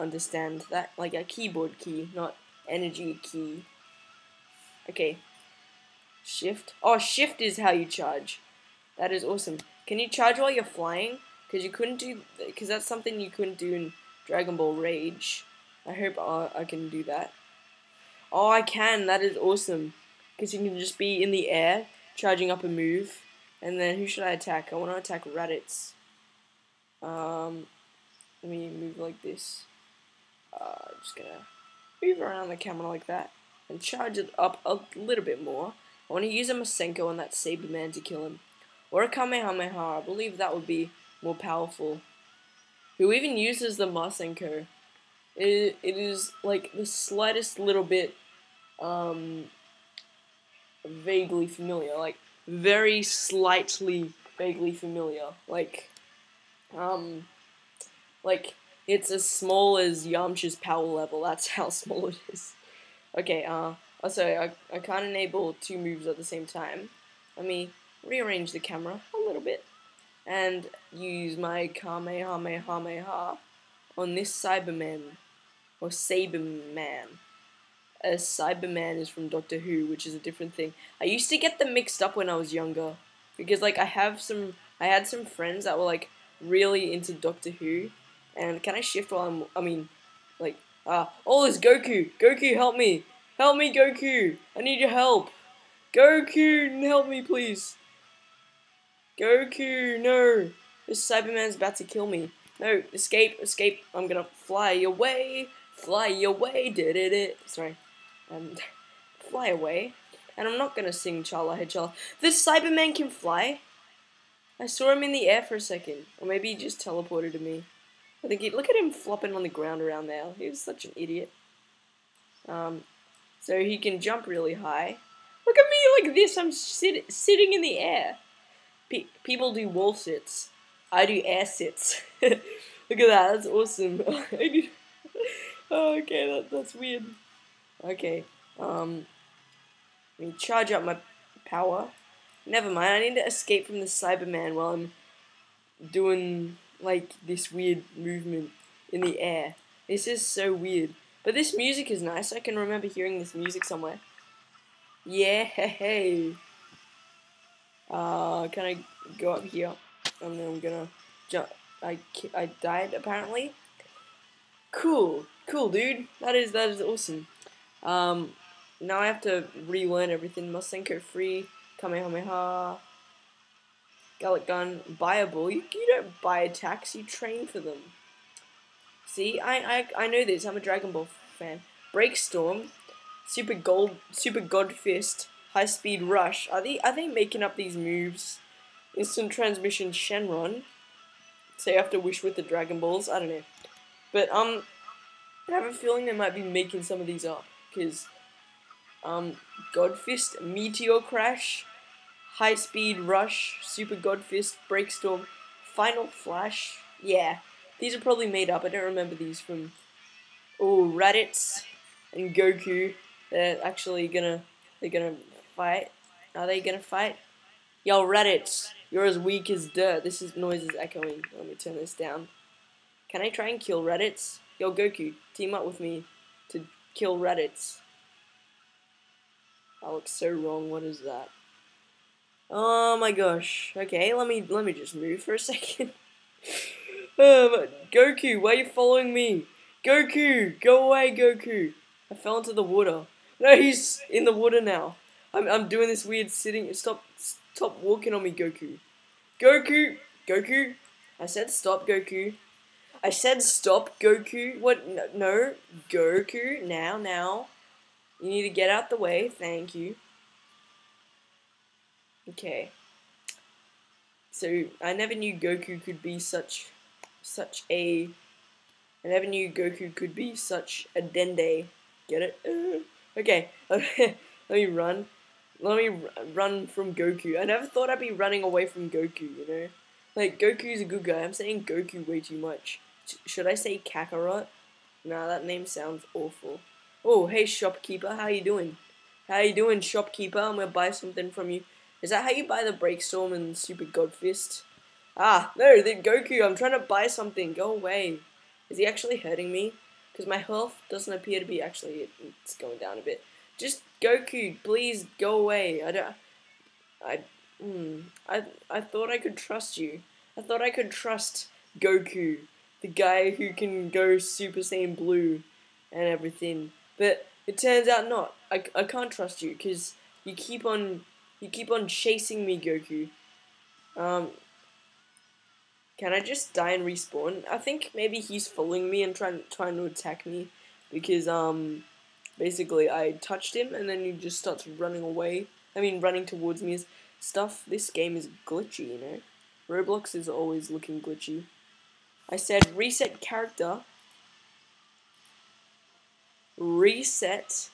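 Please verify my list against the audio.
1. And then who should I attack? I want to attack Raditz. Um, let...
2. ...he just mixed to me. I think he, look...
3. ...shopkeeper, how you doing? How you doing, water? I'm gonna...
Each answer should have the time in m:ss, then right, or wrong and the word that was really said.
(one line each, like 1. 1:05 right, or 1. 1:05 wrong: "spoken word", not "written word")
1. 0:23 right
2. 1:56 wrong: "teleported", not "mixed"
3. 4:47 wrong: "shopkeeper", not "water".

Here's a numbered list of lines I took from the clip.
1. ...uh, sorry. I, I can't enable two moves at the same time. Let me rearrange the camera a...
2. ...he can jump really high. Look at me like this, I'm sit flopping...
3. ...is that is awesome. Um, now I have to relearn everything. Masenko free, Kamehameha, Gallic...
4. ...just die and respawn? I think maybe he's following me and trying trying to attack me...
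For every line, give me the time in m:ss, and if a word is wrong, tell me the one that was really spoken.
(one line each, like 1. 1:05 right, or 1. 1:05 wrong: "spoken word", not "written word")
1. 1:03 right
2. 2:03 wrong: "sitting", not "flopping"
3. 2:46 right
4. 5:26 right.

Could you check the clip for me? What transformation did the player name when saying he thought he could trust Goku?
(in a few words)
Super Saiyan Blue.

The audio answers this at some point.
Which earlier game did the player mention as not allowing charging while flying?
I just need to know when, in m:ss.
0:14.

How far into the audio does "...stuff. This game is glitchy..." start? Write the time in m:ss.
5:37.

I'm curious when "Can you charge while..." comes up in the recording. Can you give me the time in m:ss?
0:09.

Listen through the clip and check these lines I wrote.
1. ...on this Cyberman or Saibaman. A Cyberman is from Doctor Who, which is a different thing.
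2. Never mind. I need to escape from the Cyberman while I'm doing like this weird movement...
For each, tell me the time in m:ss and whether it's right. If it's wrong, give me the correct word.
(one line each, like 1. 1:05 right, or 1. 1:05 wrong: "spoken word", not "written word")
1. 1:13 right
2. 2:22 right.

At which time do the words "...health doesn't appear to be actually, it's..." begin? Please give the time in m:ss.
5:00.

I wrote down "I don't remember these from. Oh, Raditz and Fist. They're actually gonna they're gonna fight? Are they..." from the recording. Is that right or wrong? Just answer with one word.
wrong.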